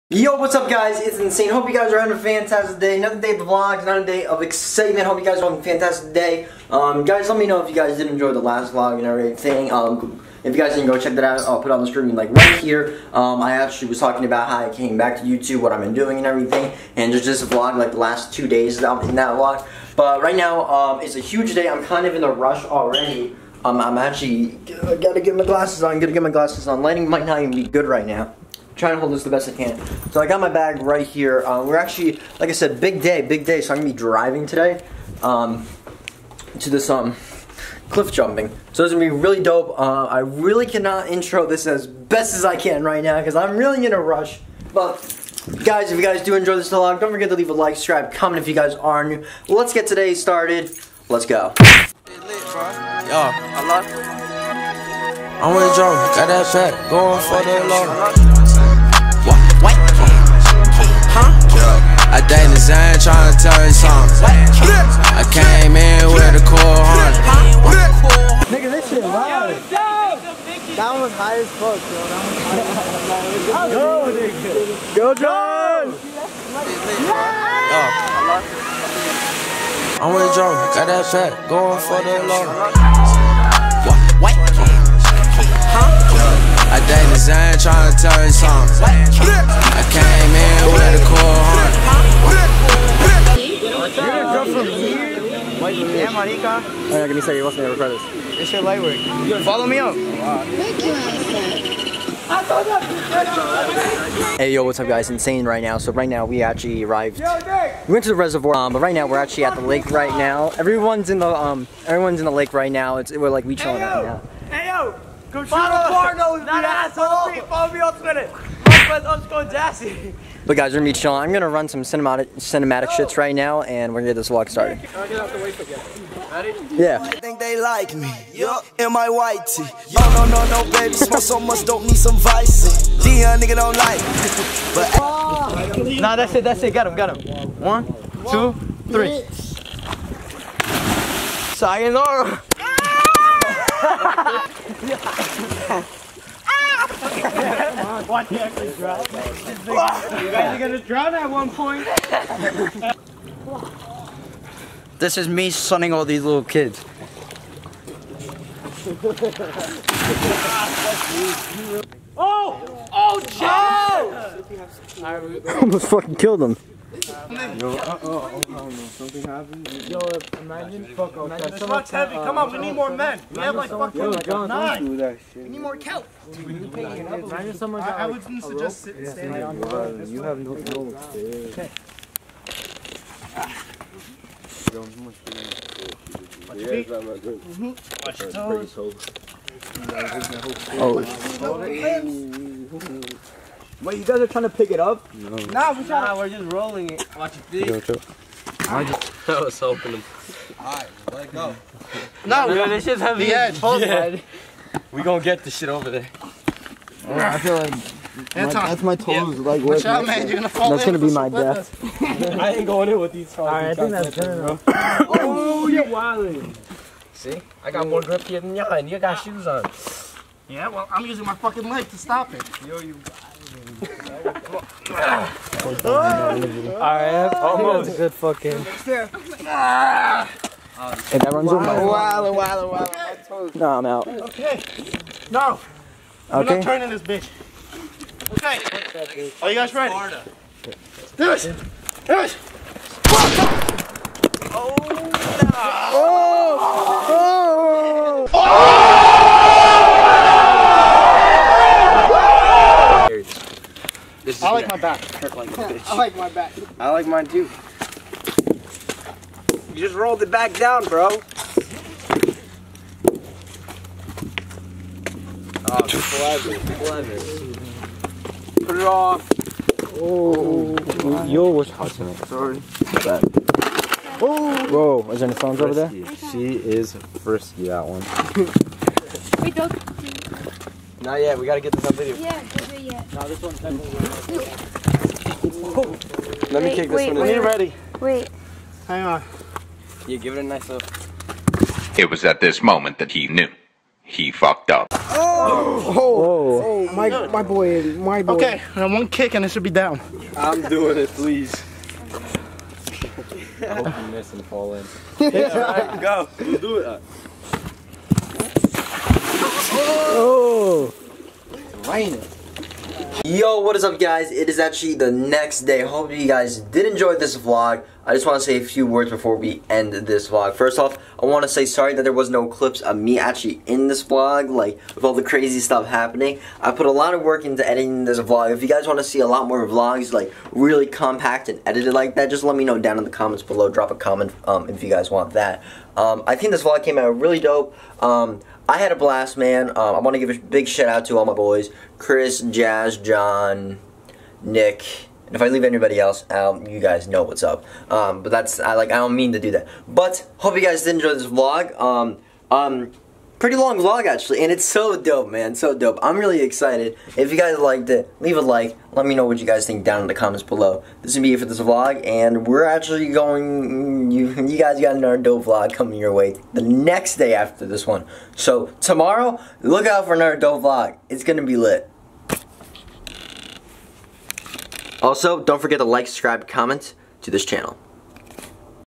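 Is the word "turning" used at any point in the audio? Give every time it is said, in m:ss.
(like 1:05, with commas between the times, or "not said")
3:56.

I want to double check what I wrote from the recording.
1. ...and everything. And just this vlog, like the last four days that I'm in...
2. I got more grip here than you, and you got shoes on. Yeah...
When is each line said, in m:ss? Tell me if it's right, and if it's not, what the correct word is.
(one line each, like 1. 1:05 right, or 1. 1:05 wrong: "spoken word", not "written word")
1. 0:16 wrong: "two", not "four"
2. 3:37 right.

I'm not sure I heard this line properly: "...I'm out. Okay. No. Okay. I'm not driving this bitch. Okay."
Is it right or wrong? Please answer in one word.
wrong.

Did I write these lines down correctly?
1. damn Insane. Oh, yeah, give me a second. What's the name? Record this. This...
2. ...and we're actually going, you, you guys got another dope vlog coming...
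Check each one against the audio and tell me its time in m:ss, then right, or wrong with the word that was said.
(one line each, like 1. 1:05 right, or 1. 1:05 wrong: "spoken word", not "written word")
1. 1:34 wrong: "Marica", not "Insane"
2. 6:02 right.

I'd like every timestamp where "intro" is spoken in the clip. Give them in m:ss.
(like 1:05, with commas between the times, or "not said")
0:41.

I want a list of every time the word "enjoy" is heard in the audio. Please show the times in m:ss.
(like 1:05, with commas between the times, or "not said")
0:08, 0:46, 5:16, 5:50.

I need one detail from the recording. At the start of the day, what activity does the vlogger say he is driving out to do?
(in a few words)
cliff jumping.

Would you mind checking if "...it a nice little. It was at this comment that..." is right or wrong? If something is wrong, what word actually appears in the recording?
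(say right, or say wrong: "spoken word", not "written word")
wrong: "moment", not "comment".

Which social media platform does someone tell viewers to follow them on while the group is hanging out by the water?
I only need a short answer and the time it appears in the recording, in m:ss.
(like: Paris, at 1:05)
Twitter, at 1:57.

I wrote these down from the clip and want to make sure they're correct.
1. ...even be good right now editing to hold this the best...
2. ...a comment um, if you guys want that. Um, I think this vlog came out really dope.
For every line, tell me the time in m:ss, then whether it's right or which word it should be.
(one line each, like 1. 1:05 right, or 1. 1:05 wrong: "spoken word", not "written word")
1. 0:27 wrong: "trying", not "editing"
2. 5:33 right.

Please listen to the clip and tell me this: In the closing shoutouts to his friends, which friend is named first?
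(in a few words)
Chris.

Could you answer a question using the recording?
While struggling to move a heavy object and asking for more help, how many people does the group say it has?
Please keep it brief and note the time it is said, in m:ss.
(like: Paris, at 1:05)
9, at 2:54.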